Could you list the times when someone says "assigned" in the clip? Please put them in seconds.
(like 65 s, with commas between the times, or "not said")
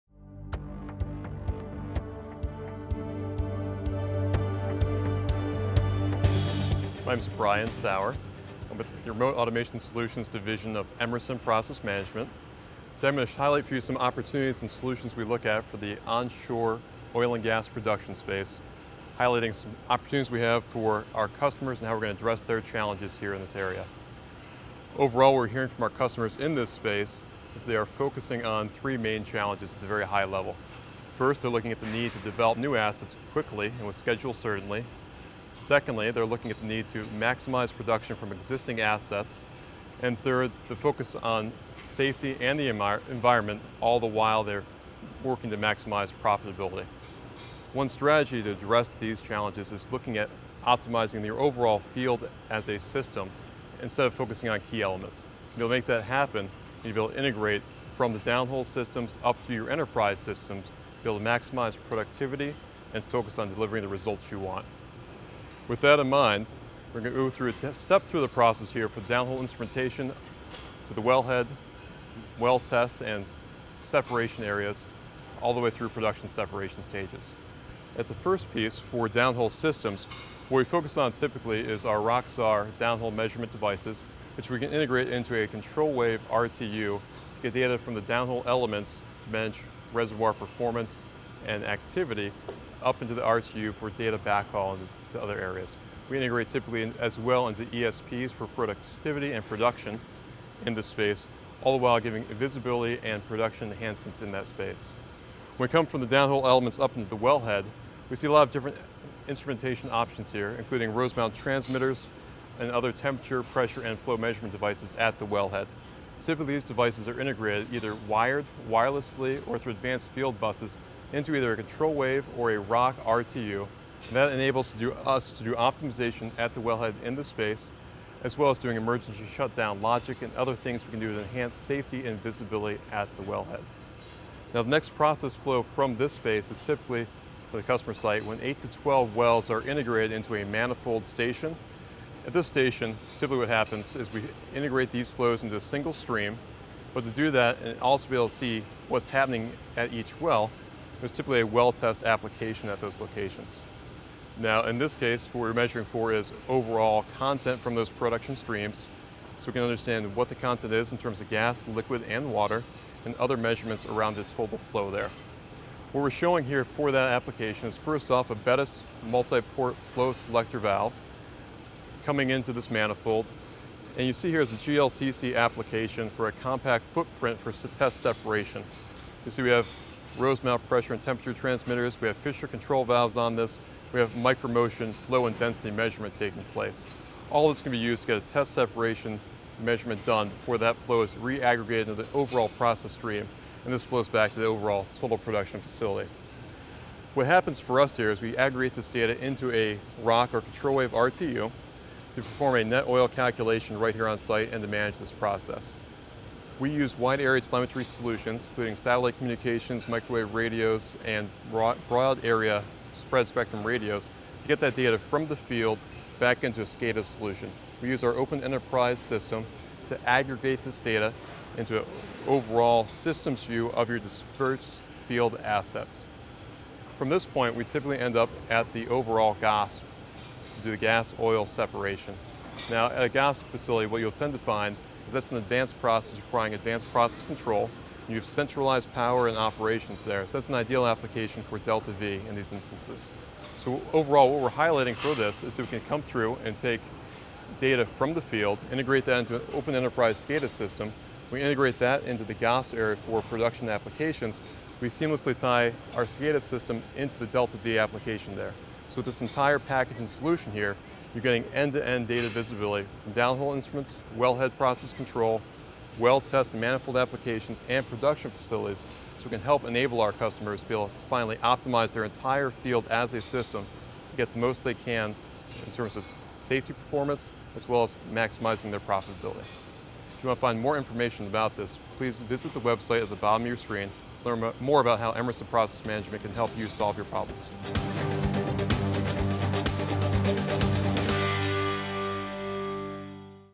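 not said.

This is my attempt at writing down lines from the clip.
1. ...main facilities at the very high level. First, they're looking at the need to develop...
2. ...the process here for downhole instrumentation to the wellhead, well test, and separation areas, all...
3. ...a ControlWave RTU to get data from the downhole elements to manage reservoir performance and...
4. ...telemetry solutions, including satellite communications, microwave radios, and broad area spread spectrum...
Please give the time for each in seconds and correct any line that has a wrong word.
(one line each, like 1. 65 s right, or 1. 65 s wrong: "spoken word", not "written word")
1. 28 s wrong: "challenges", not "facilities"
2. 68 s right
3. 85 s right
4. 207 s right.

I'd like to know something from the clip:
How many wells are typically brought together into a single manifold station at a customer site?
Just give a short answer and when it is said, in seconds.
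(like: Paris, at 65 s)
8 to 12, at 138 s.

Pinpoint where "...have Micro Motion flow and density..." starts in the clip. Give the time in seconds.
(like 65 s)
183 s.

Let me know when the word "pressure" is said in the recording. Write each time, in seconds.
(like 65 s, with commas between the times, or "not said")
113 s, 180 s.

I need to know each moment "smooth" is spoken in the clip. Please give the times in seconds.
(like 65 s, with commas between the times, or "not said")
not said.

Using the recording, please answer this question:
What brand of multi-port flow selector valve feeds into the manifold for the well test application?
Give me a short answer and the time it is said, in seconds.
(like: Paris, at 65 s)
Bettis, at 168 s.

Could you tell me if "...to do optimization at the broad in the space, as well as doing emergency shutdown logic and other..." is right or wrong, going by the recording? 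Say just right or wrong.
wrong.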